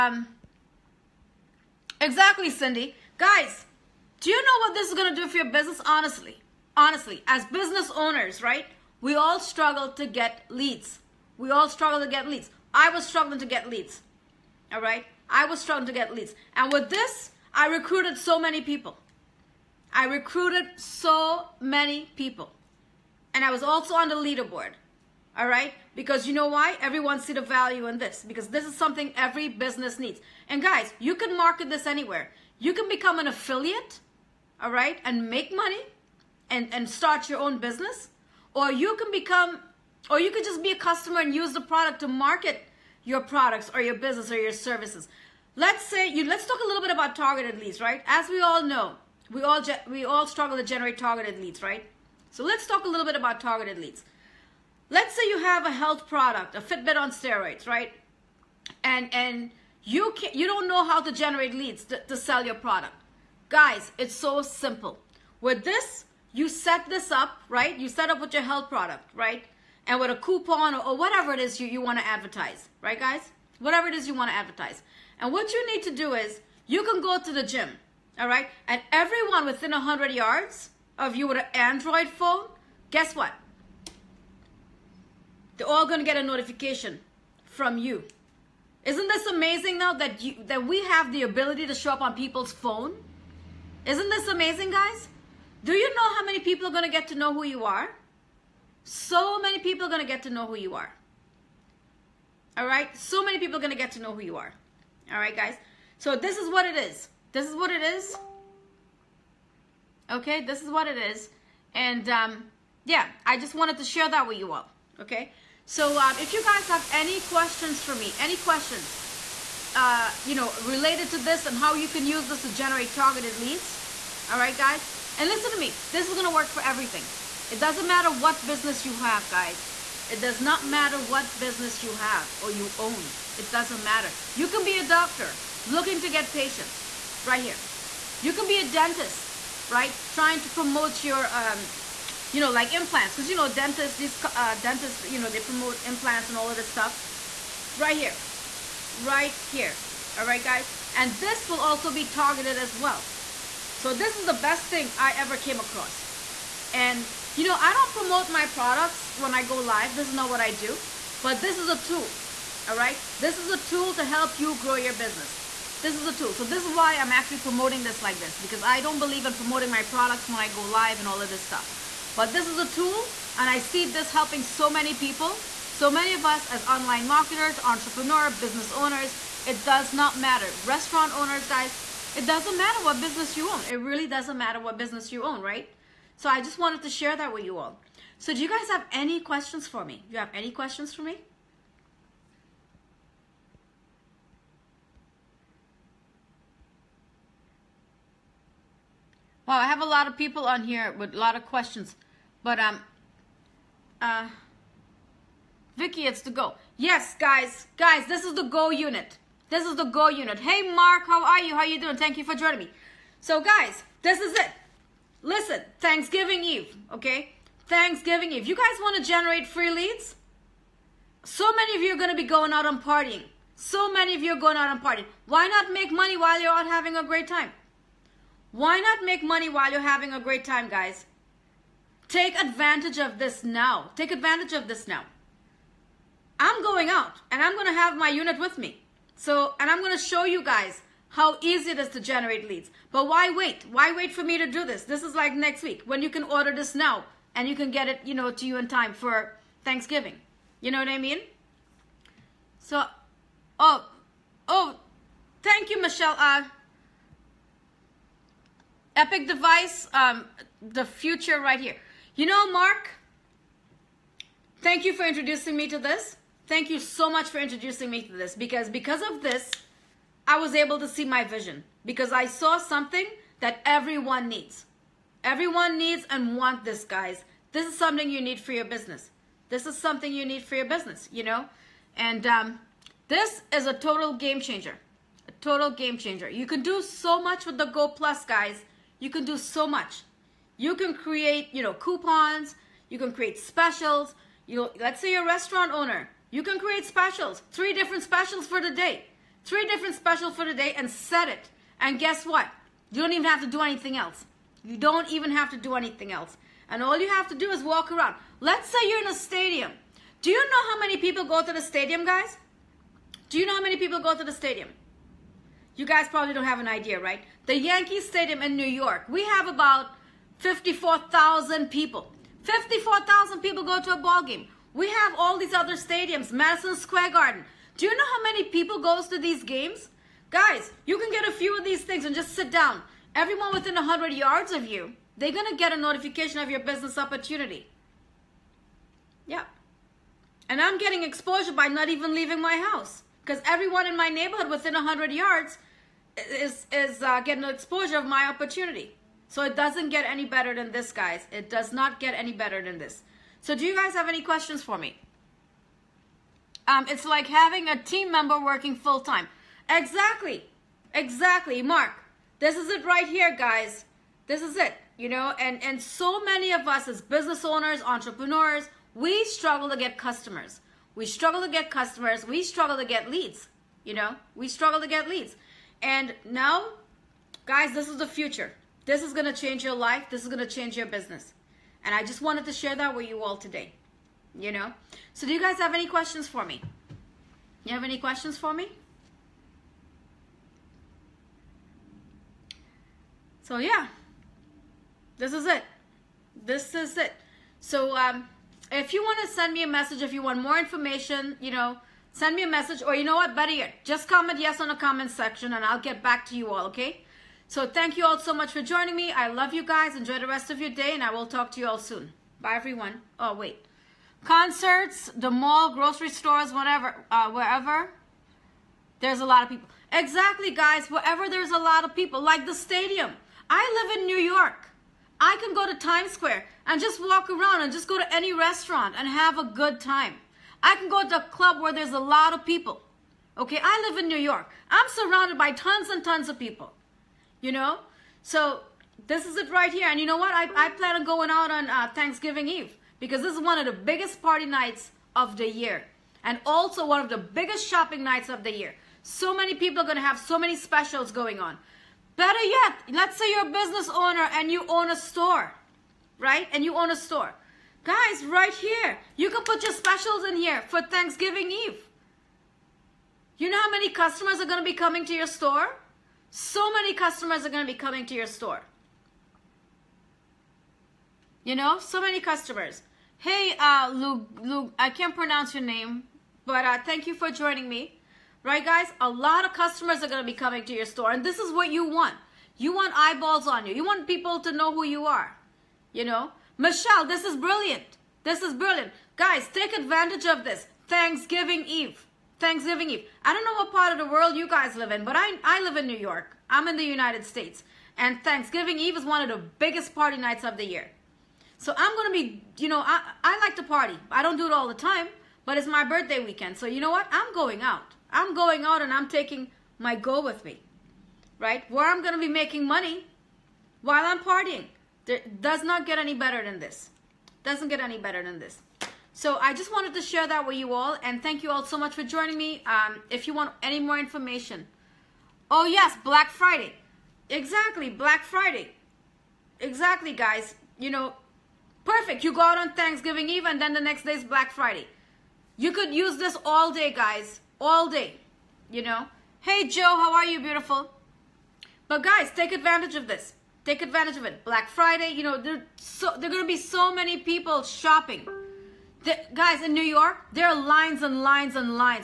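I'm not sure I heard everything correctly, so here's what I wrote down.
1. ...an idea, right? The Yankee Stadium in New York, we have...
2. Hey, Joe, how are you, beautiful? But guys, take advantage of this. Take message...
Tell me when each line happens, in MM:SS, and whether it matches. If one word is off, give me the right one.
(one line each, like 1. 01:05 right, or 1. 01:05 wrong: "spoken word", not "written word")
1. 05:16 right
2. 08:59 wrong: "advantage", not "message".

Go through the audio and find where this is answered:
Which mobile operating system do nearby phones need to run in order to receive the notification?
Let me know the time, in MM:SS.
01:21.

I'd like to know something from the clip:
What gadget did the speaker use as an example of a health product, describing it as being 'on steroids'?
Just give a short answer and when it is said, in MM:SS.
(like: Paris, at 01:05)
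Fitbit, at 00:56.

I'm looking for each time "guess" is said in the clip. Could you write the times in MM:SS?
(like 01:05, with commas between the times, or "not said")
01:22, 05:01.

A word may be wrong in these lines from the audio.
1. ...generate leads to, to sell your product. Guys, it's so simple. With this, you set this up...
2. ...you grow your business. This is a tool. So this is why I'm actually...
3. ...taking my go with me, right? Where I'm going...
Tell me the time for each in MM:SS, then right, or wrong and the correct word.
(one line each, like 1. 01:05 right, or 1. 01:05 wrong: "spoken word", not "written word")
1. 01:01 right
2. 02:44 right
3. 08:29 right.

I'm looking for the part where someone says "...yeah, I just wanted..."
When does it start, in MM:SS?
01:52.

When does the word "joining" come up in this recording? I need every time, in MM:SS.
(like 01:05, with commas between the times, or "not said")
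03:32, 06:48, 07:57, 08:42.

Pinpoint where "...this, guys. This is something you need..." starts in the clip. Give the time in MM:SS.
04:36.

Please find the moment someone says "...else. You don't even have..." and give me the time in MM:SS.
05:03.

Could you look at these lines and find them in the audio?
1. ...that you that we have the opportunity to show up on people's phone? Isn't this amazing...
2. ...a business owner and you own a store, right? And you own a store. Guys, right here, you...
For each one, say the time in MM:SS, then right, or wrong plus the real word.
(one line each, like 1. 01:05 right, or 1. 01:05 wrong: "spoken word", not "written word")
1. 01:29 wrong: "ability", not "opportunity"
2. 07:33 right.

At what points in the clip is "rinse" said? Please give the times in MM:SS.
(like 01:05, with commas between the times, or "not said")
not said.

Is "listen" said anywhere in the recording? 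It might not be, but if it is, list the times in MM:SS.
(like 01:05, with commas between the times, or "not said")
02:05, 03:35.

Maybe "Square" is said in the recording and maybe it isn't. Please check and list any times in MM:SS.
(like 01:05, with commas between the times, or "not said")
05:26, 07:06.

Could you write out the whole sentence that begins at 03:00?
Restaurant owners, guys, it doesn't matter what business you own.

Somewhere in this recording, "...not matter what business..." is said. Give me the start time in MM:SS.
02:10.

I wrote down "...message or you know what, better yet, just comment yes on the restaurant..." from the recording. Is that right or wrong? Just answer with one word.
wrong.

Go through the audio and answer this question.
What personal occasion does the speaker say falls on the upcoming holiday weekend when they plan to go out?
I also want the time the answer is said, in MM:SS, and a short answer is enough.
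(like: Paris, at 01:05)
birthday weekend, at 08:25.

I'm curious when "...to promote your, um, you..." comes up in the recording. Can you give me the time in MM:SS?
02:20.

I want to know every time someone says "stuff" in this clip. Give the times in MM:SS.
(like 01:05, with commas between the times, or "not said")
02:26, 02:51.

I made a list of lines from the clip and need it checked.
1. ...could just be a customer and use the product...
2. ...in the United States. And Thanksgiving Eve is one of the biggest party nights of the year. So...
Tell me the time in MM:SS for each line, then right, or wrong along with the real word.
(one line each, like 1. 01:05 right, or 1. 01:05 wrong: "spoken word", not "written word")
1. 00:40 right
2. 08:16 right.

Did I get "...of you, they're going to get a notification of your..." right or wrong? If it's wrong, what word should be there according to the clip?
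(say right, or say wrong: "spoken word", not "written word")
right.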